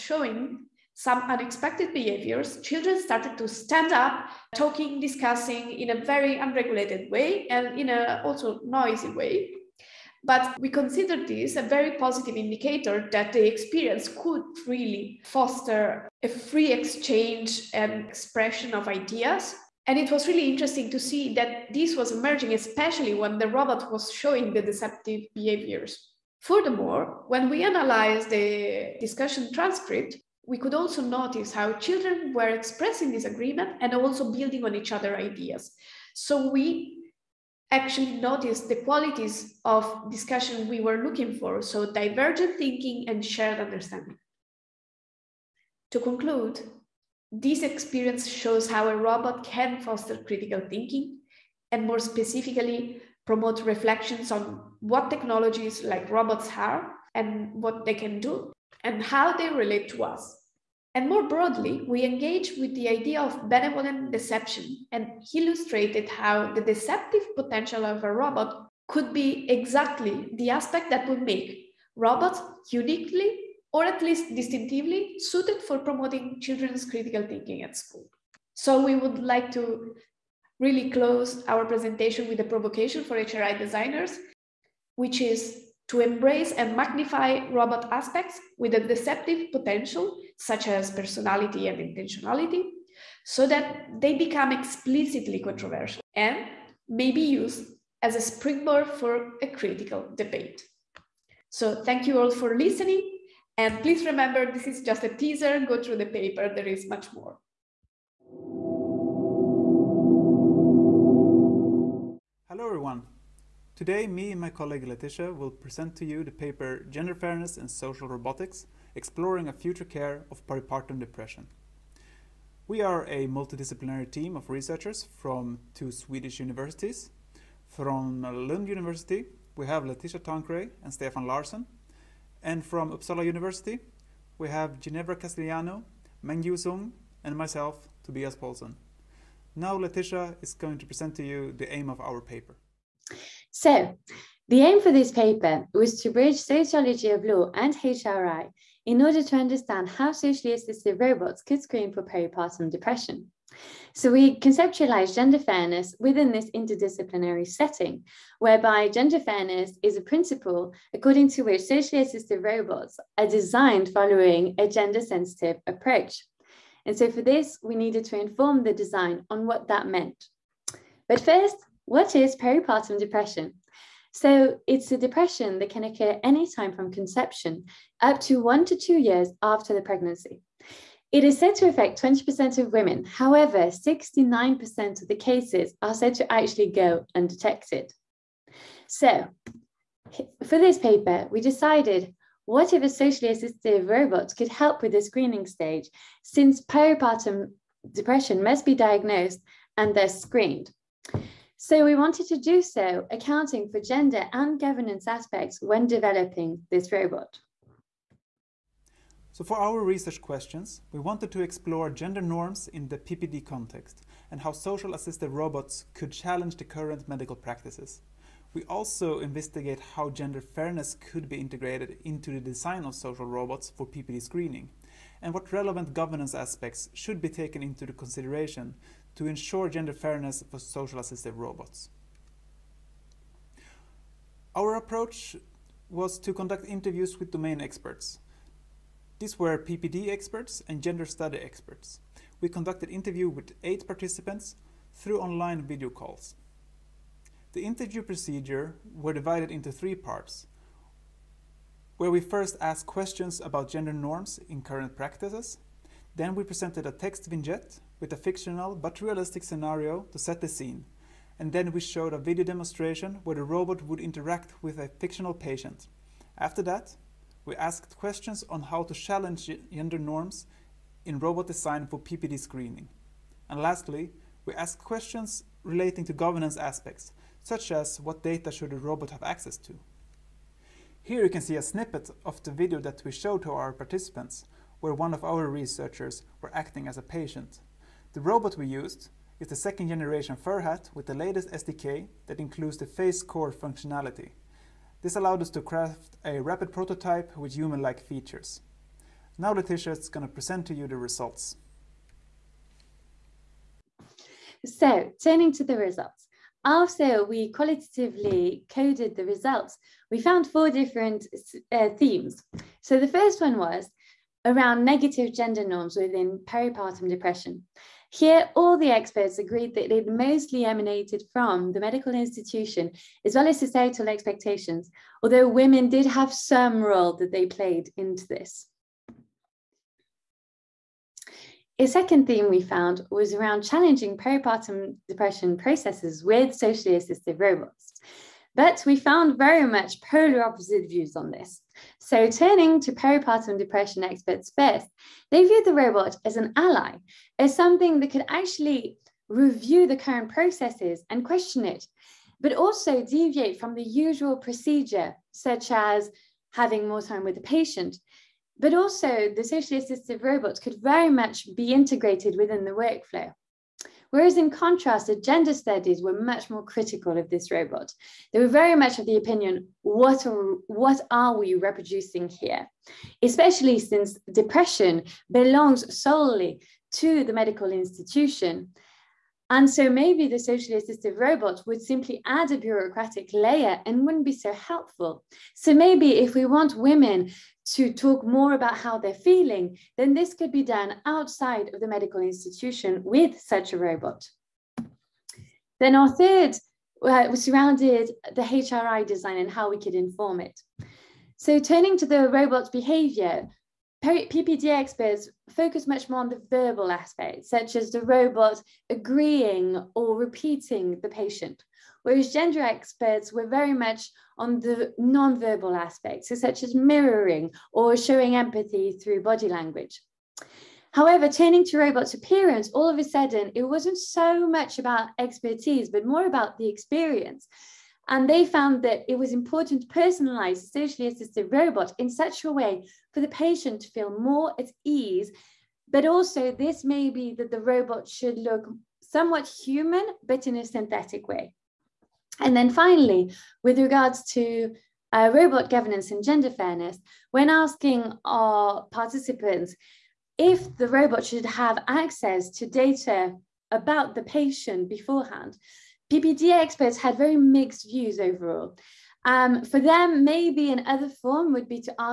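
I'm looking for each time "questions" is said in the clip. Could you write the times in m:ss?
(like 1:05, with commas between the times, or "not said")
3:30, 4:12, 4:27, 4:34, 5:51.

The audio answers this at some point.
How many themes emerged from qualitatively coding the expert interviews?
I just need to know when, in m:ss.
5:10.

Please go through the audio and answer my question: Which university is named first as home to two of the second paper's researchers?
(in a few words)
Lund University.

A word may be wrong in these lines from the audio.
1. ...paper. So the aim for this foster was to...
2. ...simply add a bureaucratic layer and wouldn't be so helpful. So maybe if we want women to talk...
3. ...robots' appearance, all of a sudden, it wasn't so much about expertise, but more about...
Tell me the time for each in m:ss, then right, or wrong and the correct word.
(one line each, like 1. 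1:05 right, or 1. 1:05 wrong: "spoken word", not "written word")
1. 2:22 wrong: "paper", not "foster"
2. 6:21 right
3. 7:01 right.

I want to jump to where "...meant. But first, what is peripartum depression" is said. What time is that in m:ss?
2:49.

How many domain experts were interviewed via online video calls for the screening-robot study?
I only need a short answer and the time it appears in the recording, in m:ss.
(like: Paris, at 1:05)
8, at 4:03.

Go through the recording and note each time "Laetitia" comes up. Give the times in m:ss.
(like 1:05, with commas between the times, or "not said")
1:54, 2:09, 2:19, 4:59.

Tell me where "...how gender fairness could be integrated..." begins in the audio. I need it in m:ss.
3:39.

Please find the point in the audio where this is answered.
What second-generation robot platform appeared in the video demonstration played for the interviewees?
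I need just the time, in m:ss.
4:50.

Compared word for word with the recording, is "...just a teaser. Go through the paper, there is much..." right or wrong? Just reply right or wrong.
right.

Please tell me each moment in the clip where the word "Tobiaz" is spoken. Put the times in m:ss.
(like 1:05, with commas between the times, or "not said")
2:18.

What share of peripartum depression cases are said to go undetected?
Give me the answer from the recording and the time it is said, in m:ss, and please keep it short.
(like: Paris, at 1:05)
69%, at 3:03.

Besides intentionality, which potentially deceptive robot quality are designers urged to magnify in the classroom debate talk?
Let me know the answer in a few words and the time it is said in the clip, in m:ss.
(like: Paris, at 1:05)
personality, at 1:30.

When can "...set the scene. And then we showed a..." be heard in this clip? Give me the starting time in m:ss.
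4:20.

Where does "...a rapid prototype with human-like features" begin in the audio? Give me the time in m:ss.
4:56.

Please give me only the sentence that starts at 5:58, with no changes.
But also, the socially assistive robots could very much be integrated within the workflow.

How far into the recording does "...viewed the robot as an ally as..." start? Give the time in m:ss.
5:45.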